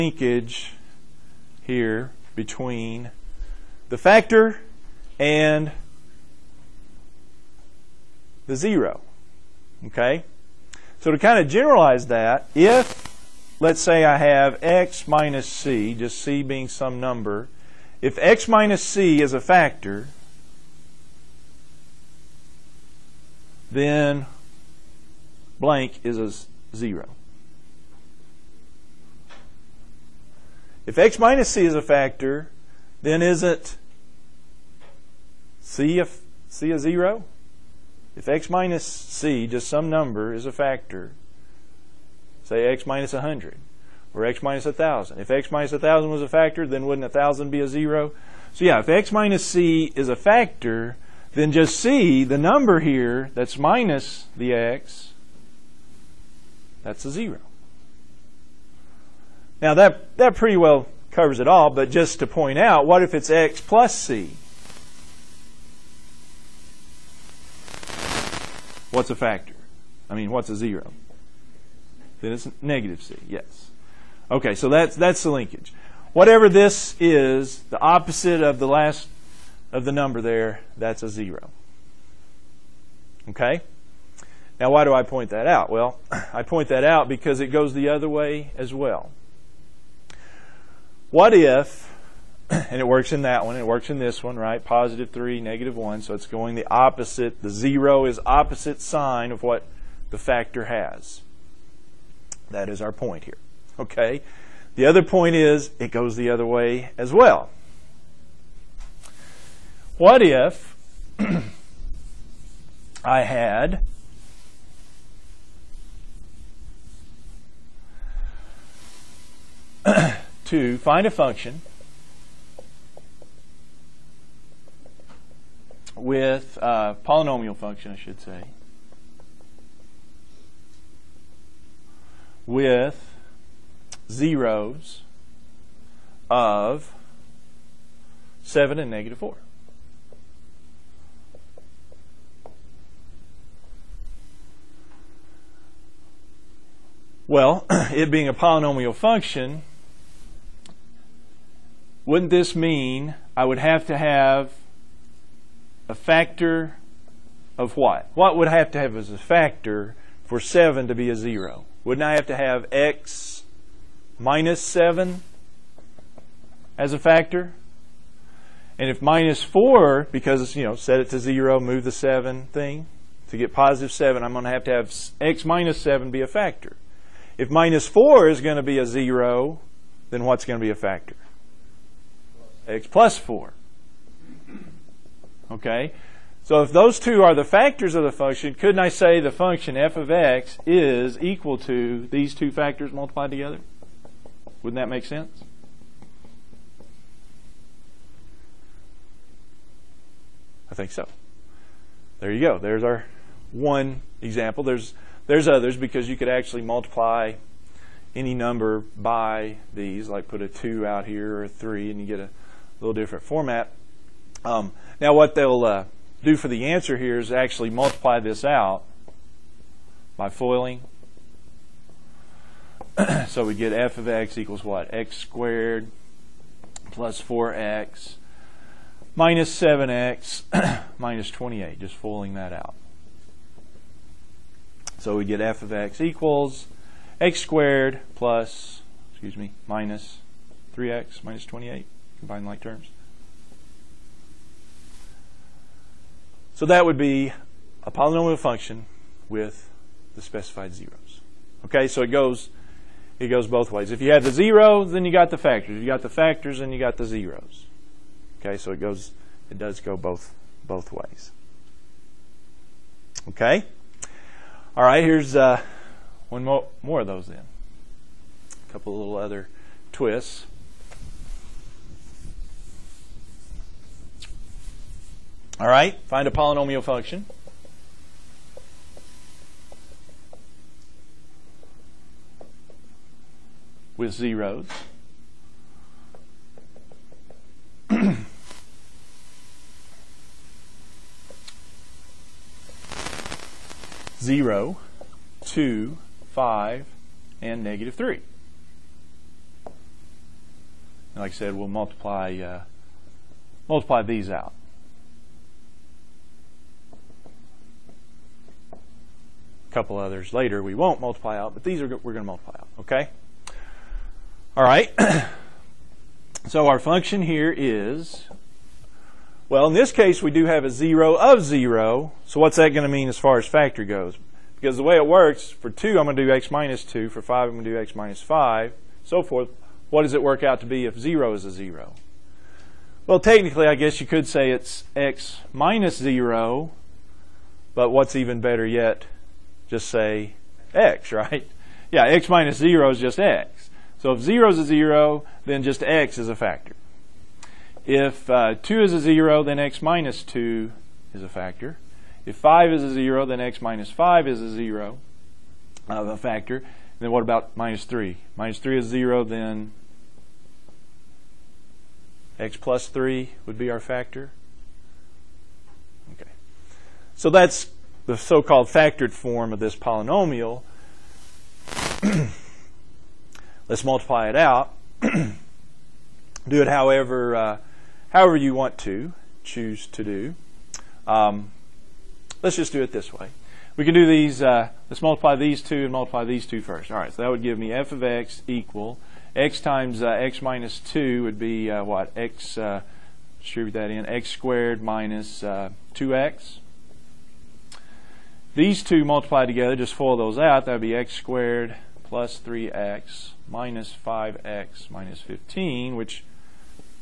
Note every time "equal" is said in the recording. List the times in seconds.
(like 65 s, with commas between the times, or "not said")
191 s, 224 s, 235 s, 388 s.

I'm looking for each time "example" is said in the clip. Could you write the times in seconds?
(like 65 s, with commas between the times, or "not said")
204 s.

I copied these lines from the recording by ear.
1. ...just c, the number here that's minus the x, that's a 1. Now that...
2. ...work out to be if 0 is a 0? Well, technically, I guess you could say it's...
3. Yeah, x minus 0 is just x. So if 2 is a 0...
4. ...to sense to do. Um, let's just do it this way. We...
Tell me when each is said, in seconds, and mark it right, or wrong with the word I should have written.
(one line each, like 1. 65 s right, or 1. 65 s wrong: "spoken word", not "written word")
1. 51 s wrong: "0", not "1"
2. 330 s right
3. 341 s wrong: "0", not "2"
4. 378 s wrong: "choose", not "sense".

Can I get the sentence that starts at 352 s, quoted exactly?
If 5 is a 0, then x minus 5 is a 0 a factor.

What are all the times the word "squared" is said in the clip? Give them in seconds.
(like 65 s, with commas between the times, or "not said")
225 s, 237 s, 394 s, 401 s.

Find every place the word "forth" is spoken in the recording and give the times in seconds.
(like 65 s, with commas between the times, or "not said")
329 s.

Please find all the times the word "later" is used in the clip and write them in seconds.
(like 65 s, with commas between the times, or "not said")
310 s.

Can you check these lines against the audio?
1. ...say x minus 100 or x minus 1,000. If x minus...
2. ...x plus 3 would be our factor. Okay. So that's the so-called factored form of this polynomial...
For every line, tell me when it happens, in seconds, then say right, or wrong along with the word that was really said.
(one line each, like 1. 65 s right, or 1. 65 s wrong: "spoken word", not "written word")
1. 42 s right
2. 362 s right.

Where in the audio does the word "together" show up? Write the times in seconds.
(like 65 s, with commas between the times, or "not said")
193 s, 399 s.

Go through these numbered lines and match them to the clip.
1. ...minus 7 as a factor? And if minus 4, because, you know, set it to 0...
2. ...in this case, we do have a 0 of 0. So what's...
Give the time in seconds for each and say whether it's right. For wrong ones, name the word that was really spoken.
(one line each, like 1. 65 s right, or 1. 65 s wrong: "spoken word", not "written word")
1. 164 s right
2. 319 s right.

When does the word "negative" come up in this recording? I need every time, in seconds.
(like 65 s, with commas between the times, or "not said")
72 s, 95 s, 138 s, 297 s.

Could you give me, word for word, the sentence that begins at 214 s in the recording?
Um, now what they'll uh, do for the answer here is actually multiply this out by foiling.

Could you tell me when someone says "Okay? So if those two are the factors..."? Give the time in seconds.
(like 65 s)
185 s.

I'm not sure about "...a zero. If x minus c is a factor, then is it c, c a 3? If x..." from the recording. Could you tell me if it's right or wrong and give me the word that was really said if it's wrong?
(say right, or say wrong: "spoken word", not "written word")
wrong: "0", not "3".